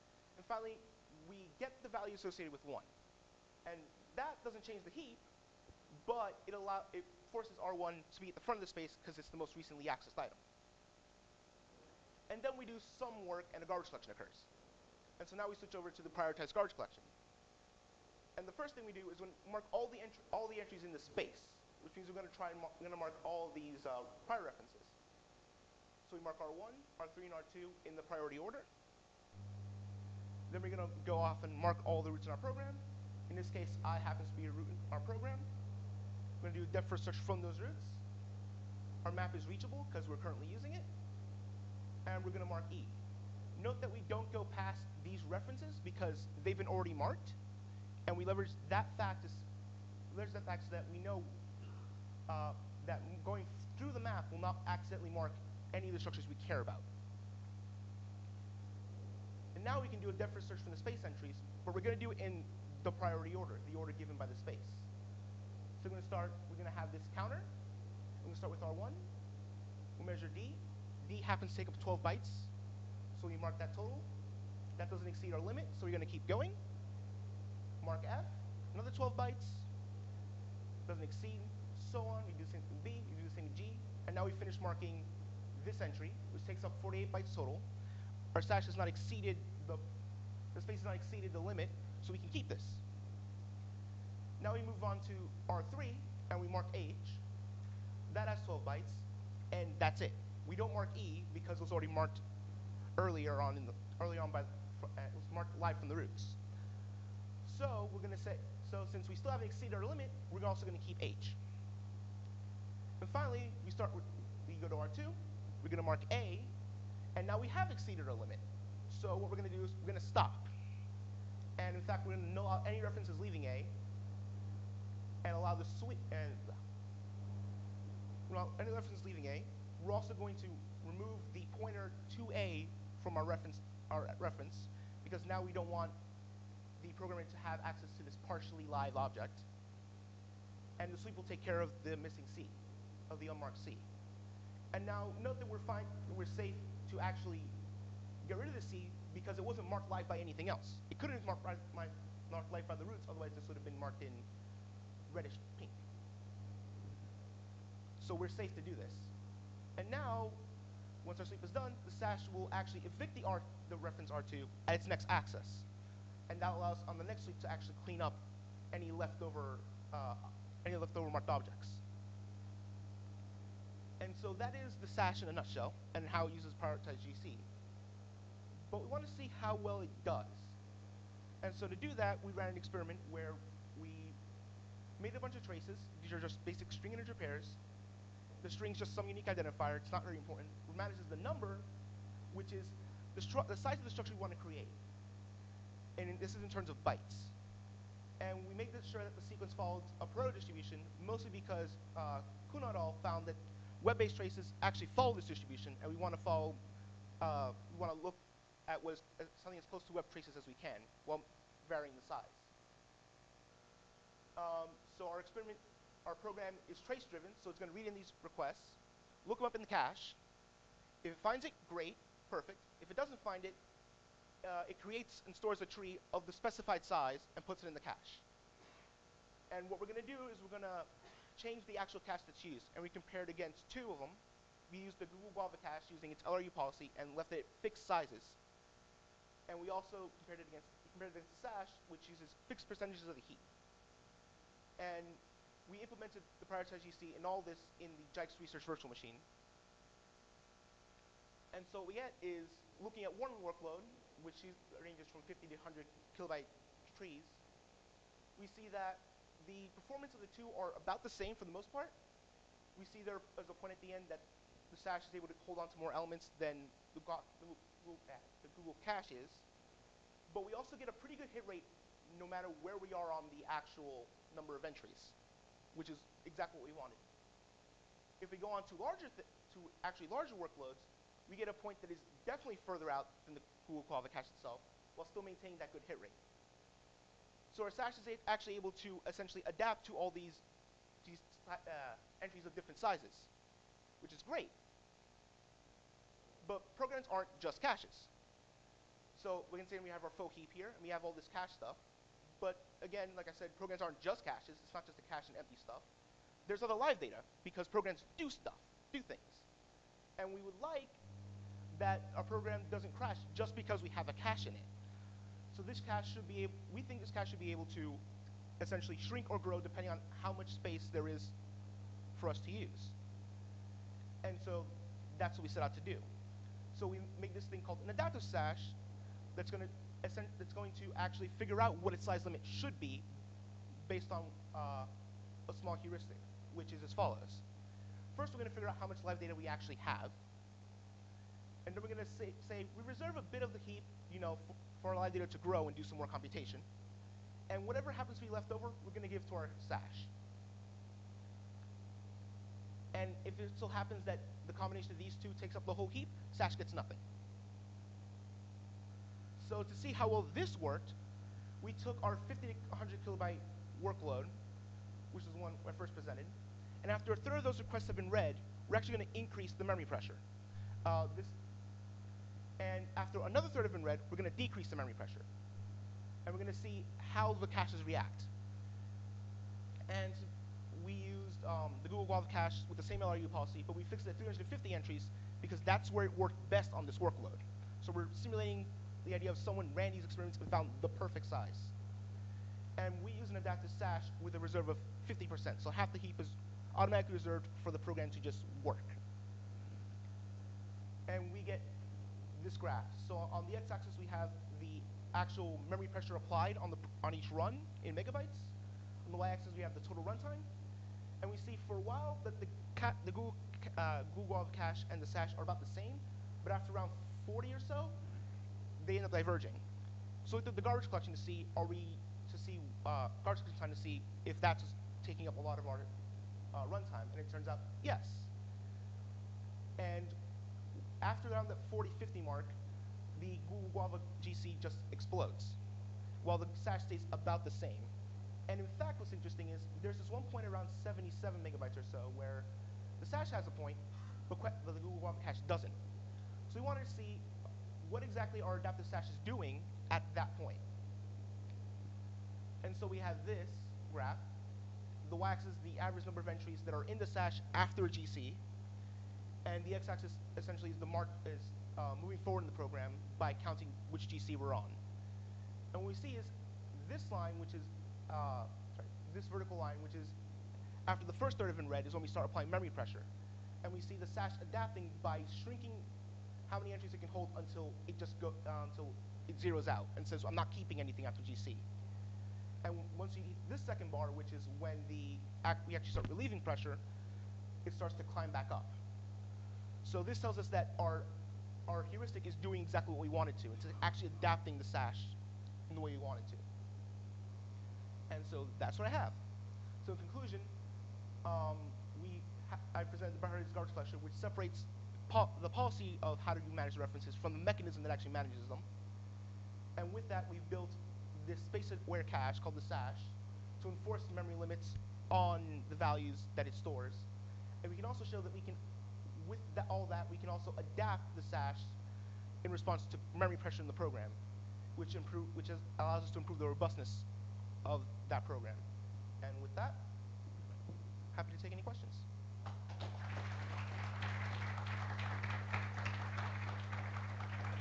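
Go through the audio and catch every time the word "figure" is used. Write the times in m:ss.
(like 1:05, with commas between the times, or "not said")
5:31, 5:38.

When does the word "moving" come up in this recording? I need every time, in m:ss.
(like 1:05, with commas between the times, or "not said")
7:42.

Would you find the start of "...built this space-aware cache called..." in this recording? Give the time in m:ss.
8:30.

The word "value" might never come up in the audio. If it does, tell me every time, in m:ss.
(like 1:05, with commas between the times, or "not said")
0:01, 8:35.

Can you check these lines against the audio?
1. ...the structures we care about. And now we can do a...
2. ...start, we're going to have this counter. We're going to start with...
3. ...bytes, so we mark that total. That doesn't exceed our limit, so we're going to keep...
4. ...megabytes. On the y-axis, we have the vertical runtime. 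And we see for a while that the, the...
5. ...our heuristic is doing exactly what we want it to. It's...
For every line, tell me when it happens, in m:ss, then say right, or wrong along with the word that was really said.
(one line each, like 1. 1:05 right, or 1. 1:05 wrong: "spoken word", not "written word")
1. 0:55 right
2. 1:06 right
3. 1:12 right
4. 6:47 wrong: "total", not "vertical"
5. 8:11 right.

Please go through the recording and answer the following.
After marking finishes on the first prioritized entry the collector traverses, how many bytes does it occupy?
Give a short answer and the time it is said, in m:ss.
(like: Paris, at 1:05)
48 bytes, at 1:26.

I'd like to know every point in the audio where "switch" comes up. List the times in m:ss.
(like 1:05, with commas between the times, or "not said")
0:15, 2:05.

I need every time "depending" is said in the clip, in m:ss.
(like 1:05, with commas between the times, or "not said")
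5:19.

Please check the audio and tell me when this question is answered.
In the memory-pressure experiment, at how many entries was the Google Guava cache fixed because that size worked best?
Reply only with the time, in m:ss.
6:24.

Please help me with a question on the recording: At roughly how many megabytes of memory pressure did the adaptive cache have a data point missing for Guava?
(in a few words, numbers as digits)
77 megabytes.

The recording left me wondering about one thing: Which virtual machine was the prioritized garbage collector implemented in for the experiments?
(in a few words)
Jikes Research Virtual Machine.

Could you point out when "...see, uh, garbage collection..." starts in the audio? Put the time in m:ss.
7:02.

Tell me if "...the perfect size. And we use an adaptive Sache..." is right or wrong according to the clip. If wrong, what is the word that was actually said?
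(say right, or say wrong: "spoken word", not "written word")
right.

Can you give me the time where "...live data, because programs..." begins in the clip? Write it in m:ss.
5:06.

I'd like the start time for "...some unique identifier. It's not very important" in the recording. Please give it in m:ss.
3:08.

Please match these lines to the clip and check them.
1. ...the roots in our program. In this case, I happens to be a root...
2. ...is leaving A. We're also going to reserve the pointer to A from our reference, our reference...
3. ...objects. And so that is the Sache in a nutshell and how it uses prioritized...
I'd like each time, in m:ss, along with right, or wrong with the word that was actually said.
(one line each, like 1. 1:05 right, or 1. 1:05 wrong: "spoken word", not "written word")
1. 0:32 right
2. 2:08 wrong: "remove", not "reserve"
3. 2:51 right.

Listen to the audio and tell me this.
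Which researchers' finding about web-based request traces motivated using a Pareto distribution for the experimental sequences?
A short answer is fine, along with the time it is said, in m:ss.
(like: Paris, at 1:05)
Kuhn et al., at 3:22.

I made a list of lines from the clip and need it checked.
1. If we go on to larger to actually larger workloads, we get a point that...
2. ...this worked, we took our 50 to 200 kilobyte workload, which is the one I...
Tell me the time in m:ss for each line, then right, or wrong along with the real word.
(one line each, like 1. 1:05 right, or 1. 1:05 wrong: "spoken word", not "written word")
1. 4:38 right
2. 6:00 wrong: "100", not "200".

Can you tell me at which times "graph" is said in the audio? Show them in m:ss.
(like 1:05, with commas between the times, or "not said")
6:42, 7:33.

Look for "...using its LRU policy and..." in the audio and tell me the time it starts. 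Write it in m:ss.
3:55.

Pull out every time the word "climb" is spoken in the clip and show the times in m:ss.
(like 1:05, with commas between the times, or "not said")
8:08.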